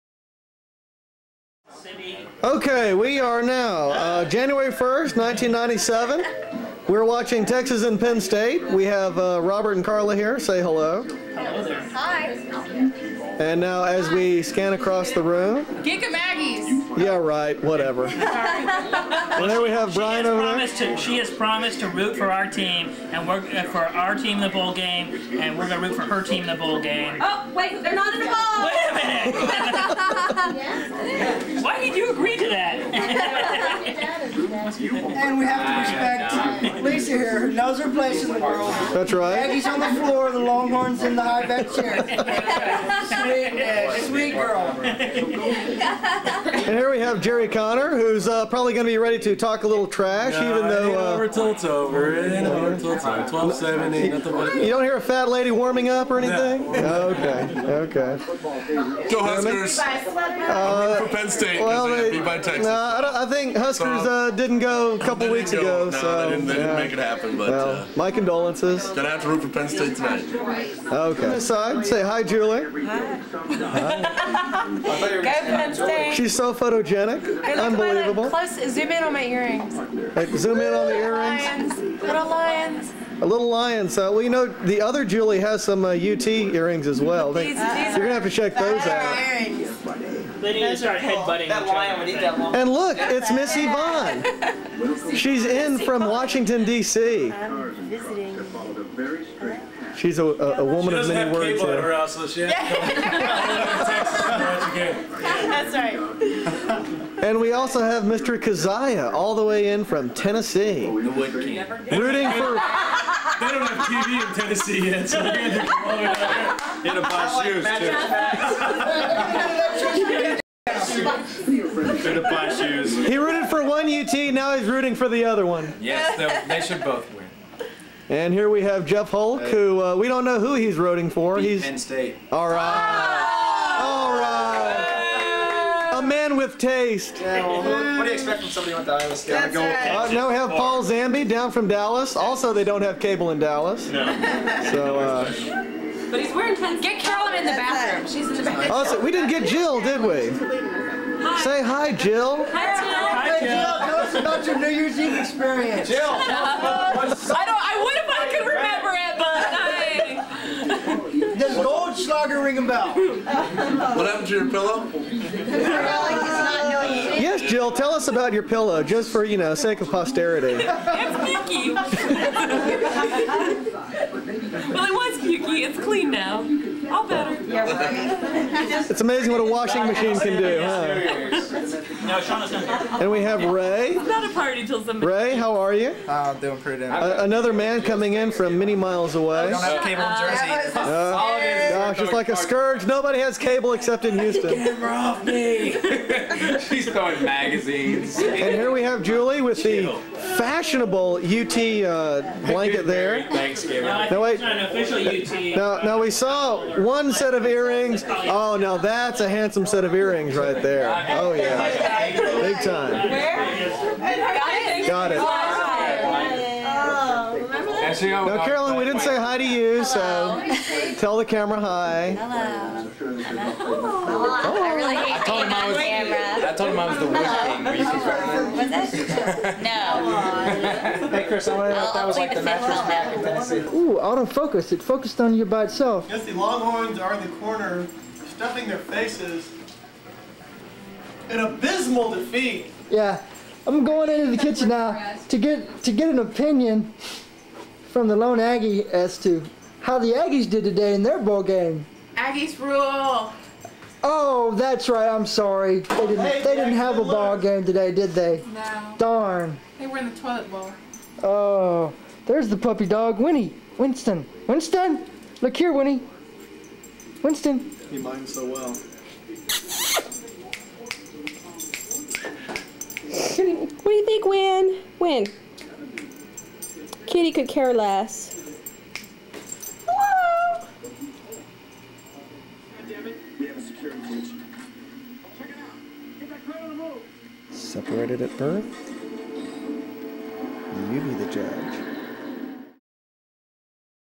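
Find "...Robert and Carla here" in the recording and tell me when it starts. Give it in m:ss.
0:09.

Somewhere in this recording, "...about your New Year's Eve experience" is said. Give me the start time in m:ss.
2:34.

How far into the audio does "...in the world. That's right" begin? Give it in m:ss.
0:38.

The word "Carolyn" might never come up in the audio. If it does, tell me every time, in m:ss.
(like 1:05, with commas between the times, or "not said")
2:27, 3:38.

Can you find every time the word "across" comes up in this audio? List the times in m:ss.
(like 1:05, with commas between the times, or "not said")
0:14.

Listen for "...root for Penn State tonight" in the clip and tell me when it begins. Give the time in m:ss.
1:09.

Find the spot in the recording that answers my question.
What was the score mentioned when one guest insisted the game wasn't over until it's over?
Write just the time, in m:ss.
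0:53.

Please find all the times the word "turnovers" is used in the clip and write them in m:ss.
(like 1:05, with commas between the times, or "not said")
not said.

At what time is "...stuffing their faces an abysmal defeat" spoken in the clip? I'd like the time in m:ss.
3:58.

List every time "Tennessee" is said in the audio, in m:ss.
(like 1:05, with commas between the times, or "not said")
1:50, 1:54, 3:53.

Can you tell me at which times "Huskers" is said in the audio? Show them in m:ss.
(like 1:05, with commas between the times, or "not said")
0:59, 1:03.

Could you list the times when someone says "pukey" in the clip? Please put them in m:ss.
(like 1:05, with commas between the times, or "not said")
2:50, 2:55.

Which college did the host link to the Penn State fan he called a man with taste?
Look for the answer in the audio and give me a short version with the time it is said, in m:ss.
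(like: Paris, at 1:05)
Iowa State, at 2:18.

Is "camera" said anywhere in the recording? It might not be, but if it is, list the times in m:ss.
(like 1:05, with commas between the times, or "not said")
3:14, 3:41, 3:45.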